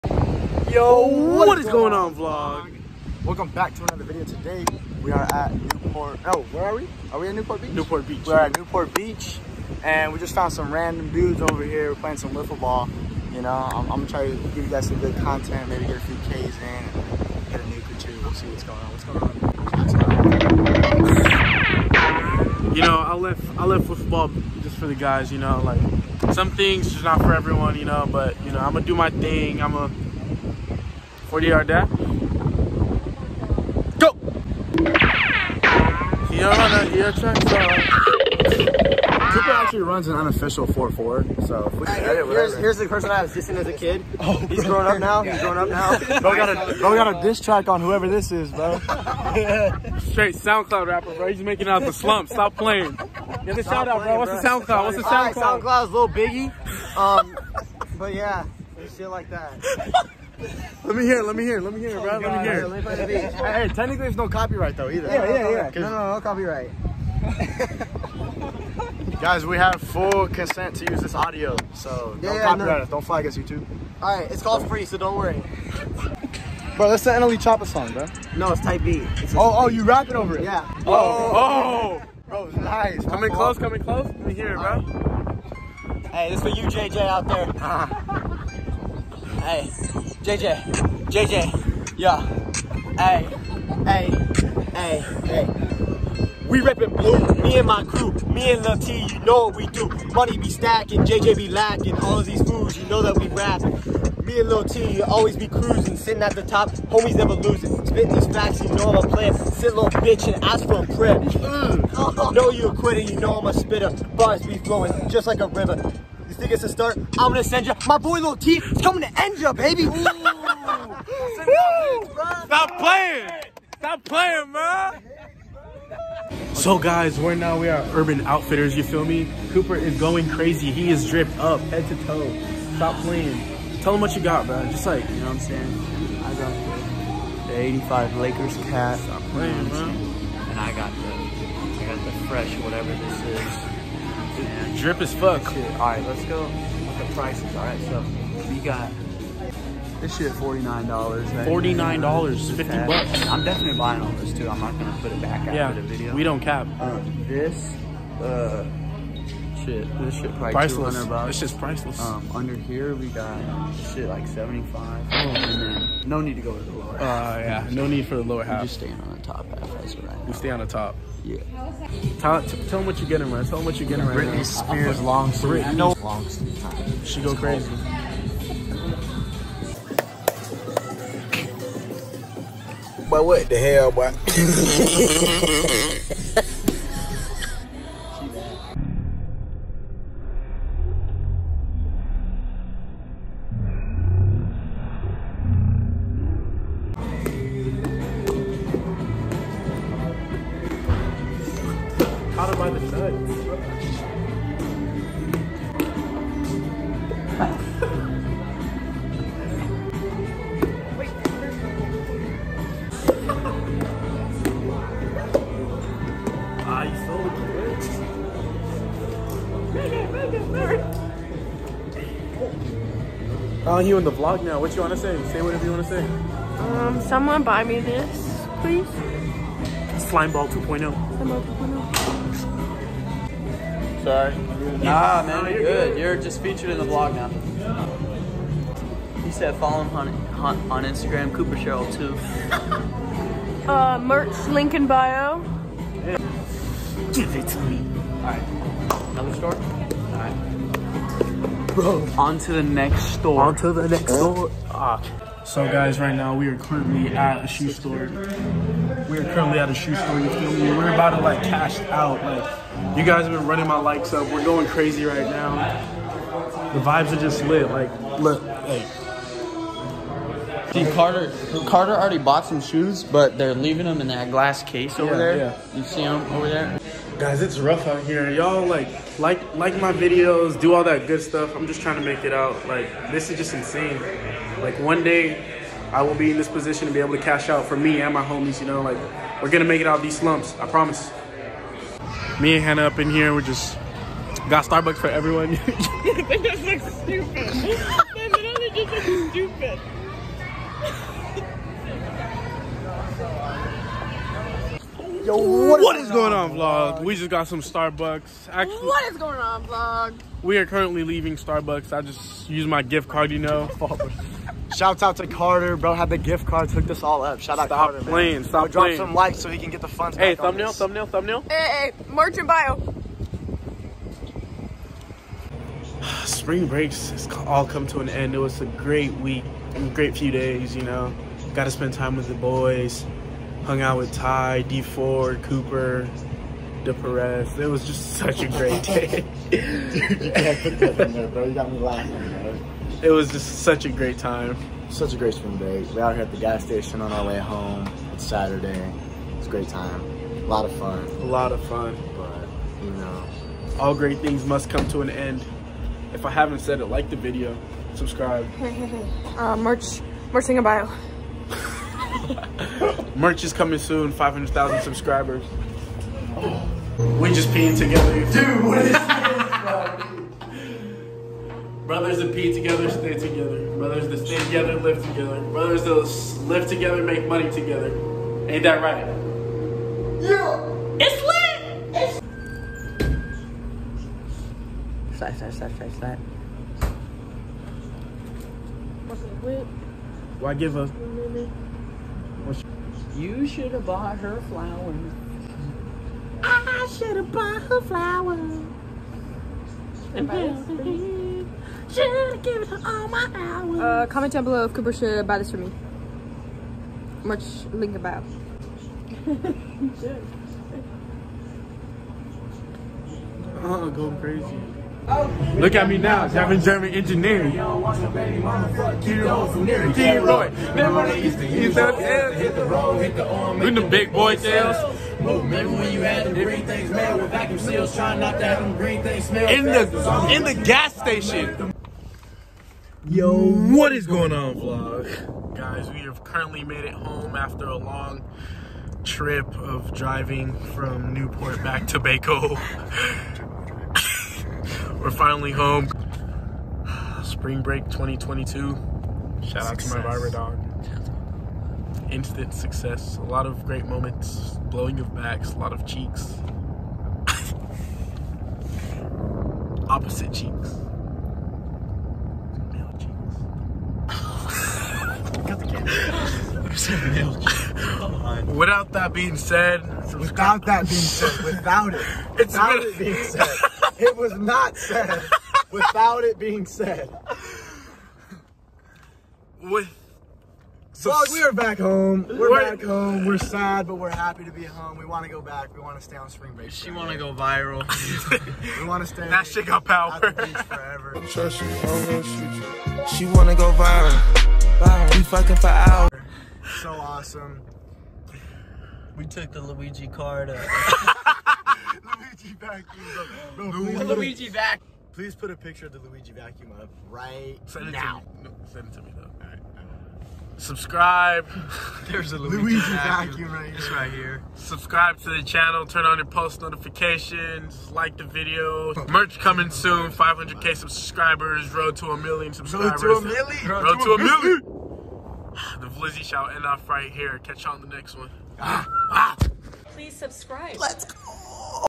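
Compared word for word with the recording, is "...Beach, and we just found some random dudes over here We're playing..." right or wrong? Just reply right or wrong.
right.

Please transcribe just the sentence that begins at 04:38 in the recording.
Y'all, like, like, like my videos, do all that good stuff.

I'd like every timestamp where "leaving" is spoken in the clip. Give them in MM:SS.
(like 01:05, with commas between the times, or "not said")
04:33, 05:11.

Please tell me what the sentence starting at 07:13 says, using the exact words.
Yo, what is going on, vlog?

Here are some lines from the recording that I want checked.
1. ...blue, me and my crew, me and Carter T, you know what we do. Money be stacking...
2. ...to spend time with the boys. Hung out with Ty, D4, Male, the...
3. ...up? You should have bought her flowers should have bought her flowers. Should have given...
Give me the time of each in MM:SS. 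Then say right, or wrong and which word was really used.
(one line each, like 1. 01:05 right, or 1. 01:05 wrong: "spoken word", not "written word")
1. 01:36 wrong: "Lil", not "Carter"
2. 05:31 wrong: "Cooper", not "Male"
3. 06:30 right.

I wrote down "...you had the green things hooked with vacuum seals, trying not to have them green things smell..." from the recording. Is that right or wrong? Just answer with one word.
wrong.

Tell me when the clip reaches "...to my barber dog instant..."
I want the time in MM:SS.
07:29.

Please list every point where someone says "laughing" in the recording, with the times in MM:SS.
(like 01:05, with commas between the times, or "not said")
05:41.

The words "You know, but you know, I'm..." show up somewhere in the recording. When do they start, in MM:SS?
00:27.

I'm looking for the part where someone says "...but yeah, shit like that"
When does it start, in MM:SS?
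00:57.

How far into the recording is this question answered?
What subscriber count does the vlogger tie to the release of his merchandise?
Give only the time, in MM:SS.
06:04.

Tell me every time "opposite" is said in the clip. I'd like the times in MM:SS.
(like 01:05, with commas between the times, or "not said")
07:39.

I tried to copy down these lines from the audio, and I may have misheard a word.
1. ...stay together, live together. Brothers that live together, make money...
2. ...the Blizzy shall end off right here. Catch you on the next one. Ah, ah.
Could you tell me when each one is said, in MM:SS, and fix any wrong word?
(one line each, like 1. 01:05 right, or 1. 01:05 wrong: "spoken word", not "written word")
1. 06:14 right
2. 08:45 right.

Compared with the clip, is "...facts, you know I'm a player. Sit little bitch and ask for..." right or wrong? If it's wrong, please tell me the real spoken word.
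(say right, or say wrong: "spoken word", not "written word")
right.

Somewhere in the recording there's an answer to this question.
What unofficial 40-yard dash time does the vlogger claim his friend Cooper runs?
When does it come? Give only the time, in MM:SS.
00:40.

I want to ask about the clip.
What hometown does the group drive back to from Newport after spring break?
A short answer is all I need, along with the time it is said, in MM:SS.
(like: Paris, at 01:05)
Baco, at 07:21.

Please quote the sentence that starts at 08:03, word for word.
We're sad, but we're happy to be home.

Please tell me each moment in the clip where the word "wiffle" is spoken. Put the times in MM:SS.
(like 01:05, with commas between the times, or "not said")
00:12, 00:23.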